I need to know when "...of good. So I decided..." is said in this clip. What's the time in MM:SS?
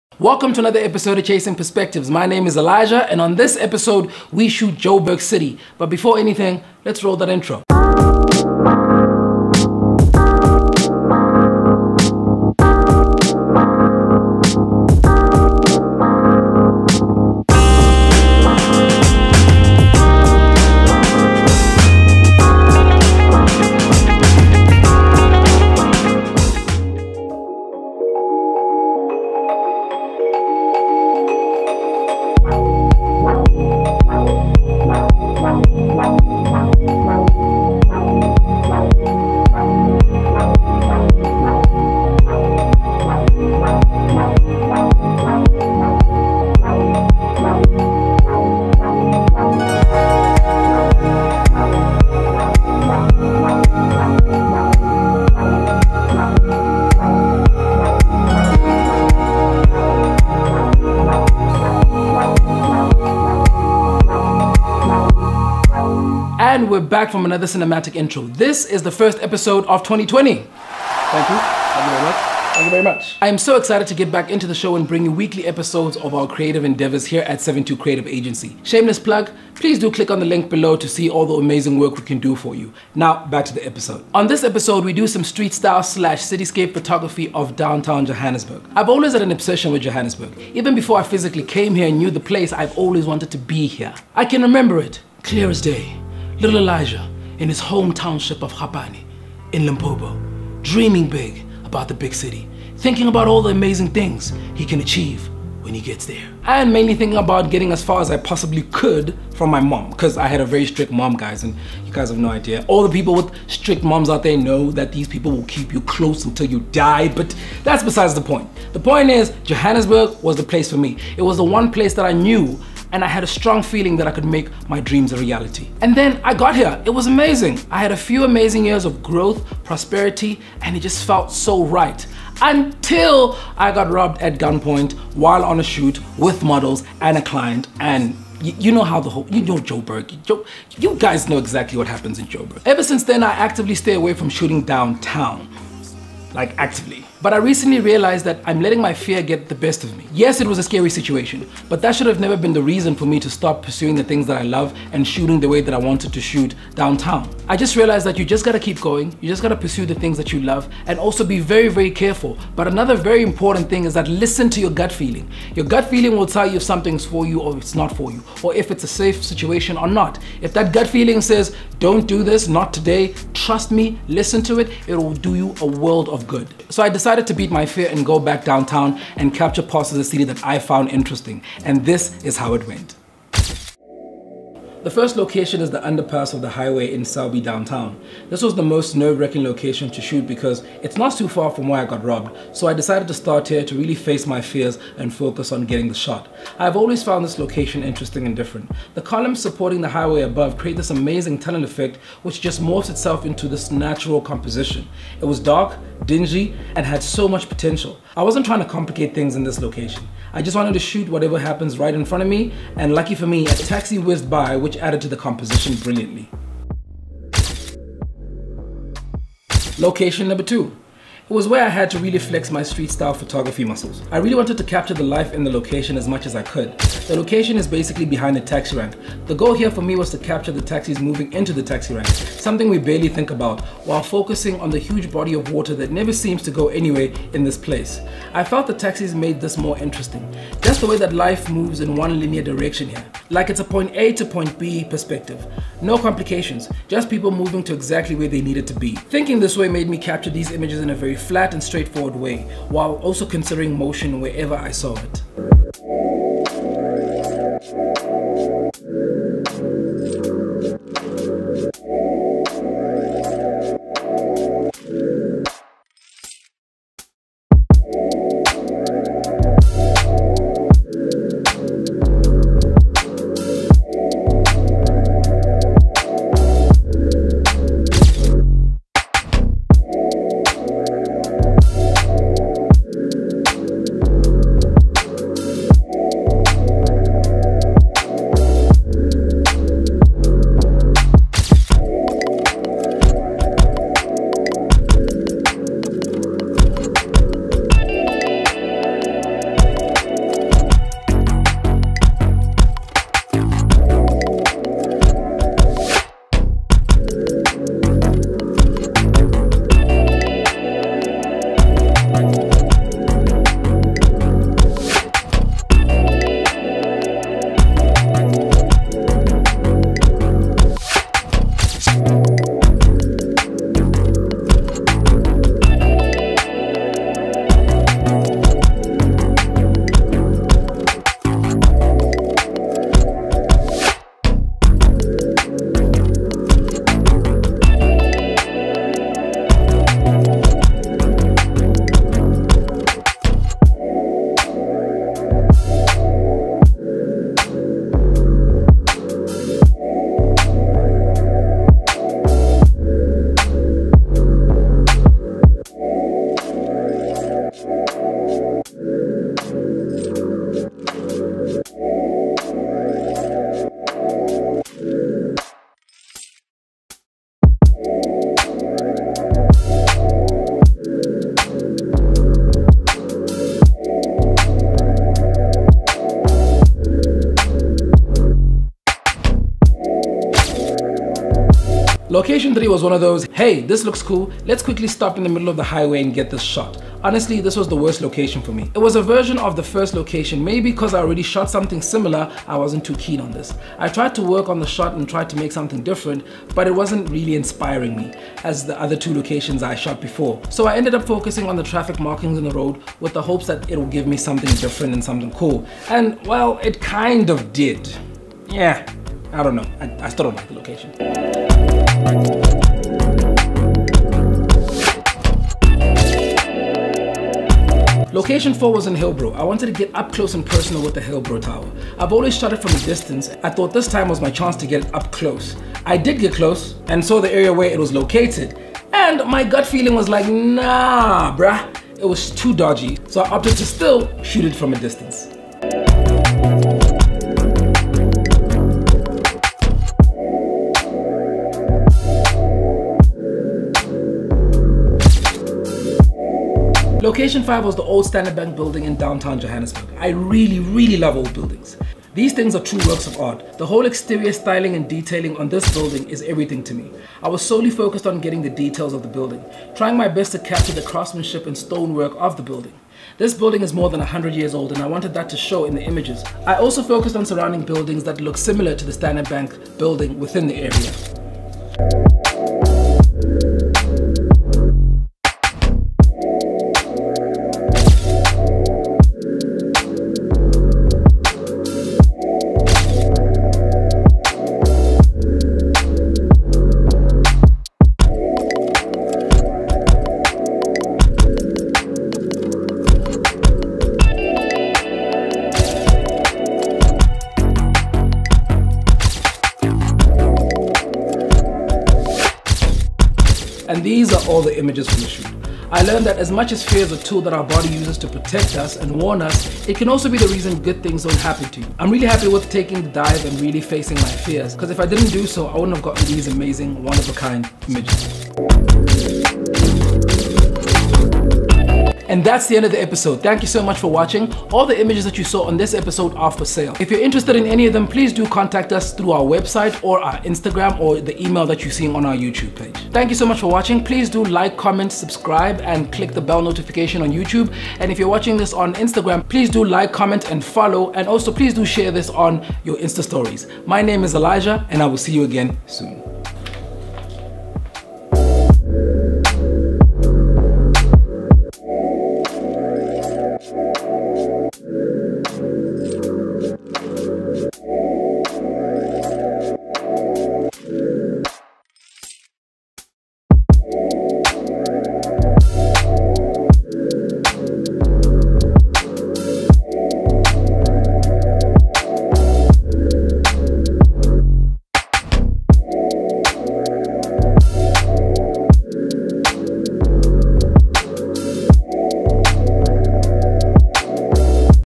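02:56.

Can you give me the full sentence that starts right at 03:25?
It was dark, dingy, and had so much potential.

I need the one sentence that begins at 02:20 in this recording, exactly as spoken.
Joe, you guys know exactly what happens in Joburg.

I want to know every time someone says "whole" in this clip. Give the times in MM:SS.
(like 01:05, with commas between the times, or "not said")
02:19, 07:33.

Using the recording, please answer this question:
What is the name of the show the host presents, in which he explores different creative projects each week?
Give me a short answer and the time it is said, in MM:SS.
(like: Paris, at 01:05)
Chasing Perspectives, at 00:01.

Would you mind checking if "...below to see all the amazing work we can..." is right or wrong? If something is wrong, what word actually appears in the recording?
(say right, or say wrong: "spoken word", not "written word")
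right.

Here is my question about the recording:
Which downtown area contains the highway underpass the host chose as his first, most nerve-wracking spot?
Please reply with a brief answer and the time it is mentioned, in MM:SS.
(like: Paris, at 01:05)
Selby, at 03:07.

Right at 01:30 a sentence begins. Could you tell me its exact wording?
Even before I physically came here and knew the place, I've always wanted to be here.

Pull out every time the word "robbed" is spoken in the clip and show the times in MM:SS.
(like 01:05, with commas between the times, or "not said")
02:13, 03:12.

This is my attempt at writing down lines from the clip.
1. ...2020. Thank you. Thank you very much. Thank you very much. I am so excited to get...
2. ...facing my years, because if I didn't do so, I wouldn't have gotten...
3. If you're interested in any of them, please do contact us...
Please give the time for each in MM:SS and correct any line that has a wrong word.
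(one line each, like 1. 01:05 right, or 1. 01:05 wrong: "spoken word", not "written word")
1. 01:09 right
2. 08:33 wrong: "fears", not "years"
3. 08:46 right.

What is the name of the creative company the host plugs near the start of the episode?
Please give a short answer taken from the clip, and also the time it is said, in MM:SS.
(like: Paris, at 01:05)
72 Creative Agency, at 01:17.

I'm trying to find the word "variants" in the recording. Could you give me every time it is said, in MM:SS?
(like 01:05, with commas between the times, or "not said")
not said.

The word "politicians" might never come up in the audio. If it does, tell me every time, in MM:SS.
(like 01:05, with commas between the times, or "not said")
not said.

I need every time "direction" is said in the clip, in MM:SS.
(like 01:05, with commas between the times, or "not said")
04:02.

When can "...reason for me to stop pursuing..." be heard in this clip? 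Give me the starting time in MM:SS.
02:32.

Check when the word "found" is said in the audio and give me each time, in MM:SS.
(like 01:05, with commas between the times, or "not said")
03:00, 03:17.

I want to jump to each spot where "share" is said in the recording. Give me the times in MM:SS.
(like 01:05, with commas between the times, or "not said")
09:01.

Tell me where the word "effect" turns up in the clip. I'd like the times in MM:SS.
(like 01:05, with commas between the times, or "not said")
03:21.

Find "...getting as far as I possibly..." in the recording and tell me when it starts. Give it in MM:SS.
01:47.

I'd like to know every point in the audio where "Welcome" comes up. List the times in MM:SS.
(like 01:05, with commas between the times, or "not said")
00:00.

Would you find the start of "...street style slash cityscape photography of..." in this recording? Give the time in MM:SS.
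01:25.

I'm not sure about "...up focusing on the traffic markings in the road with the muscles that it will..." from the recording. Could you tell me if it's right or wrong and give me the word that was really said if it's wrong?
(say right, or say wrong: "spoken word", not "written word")
wrong: "hopes", not "muscles".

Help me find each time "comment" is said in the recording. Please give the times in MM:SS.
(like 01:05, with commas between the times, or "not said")
08:54, 08:59.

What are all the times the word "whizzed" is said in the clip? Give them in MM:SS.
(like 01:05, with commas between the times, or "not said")
03:33.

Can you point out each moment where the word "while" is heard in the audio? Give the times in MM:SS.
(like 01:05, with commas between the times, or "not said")
02:15, 03:53, 04:12.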